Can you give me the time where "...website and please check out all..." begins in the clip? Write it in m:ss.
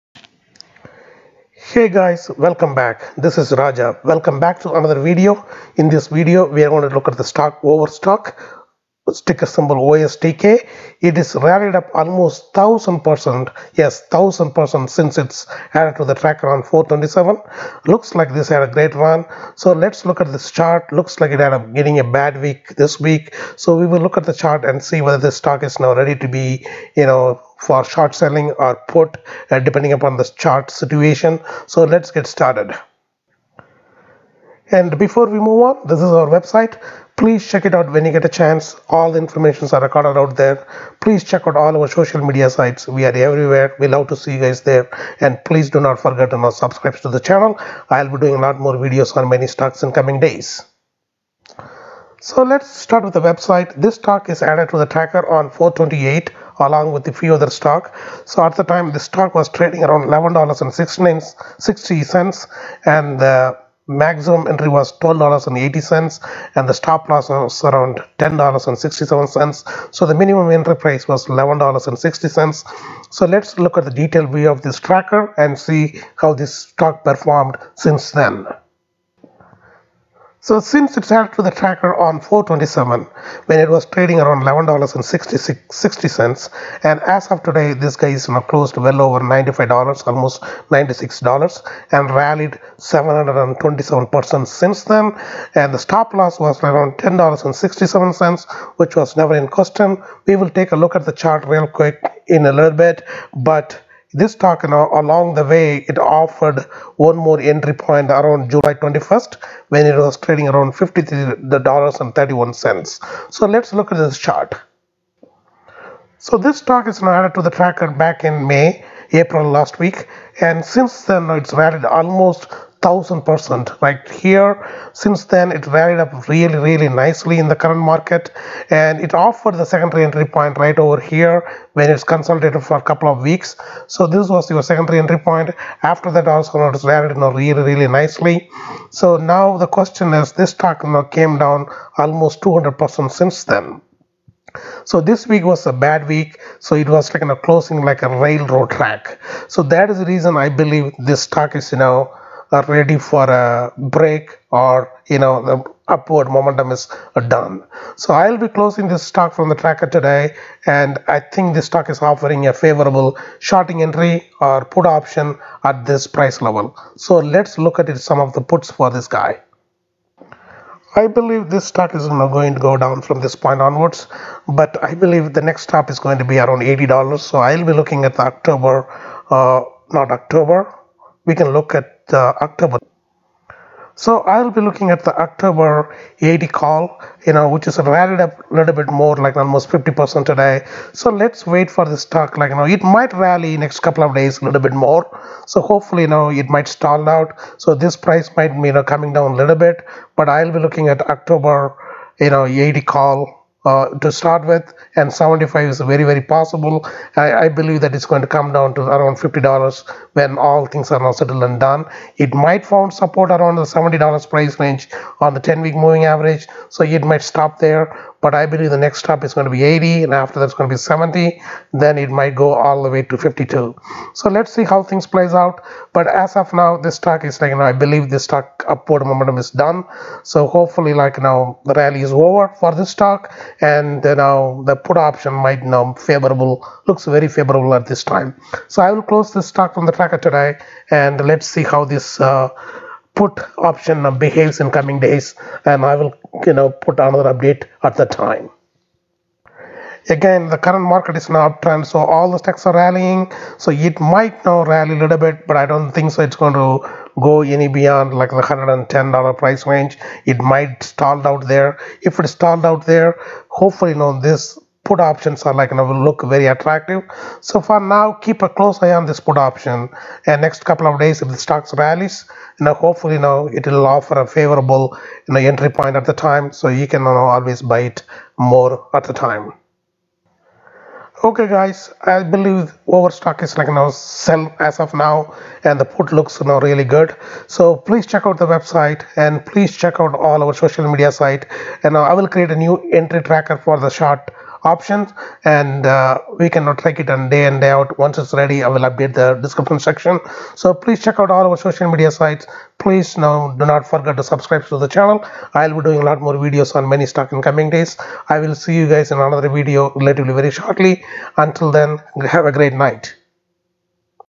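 4:48.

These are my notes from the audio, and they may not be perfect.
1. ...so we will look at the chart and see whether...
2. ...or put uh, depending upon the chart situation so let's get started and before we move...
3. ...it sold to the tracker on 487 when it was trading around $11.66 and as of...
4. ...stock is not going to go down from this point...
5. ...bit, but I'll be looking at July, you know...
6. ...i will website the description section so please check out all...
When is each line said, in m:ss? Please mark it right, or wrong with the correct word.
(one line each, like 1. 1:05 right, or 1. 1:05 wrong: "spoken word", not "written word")
1. 0:23 right
2. 0:28 right
3. 1:20 wrong: "427", not "487"
4. 2:51 right
5. 3:19 wrong: "October", not "July"
6. 4:58 wrong: "update", not "website".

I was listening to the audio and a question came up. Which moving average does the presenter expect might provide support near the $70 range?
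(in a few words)
10 week moving average.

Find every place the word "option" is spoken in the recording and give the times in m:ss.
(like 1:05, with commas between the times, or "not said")
2:44, 3:54, 4:03, 4:24, 4:29, 4:54.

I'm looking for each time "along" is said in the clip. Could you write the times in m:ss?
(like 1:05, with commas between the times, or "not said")
0:56, 1:44.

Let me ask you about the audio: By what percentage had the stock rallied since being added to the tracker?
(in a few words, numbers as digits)
727%.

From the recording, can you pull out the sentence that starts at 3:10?
So let's wait for the stock, like, you know, it might rally next couple of days a little bit more.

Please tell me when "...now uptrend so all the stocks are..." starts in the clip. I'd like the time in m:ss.
4:11.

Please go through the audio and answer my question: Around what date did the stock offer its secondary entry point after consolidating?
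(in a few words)
July 21st.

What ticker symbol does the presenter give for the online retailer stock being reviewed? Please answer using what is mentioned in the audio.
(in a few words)
OSTK.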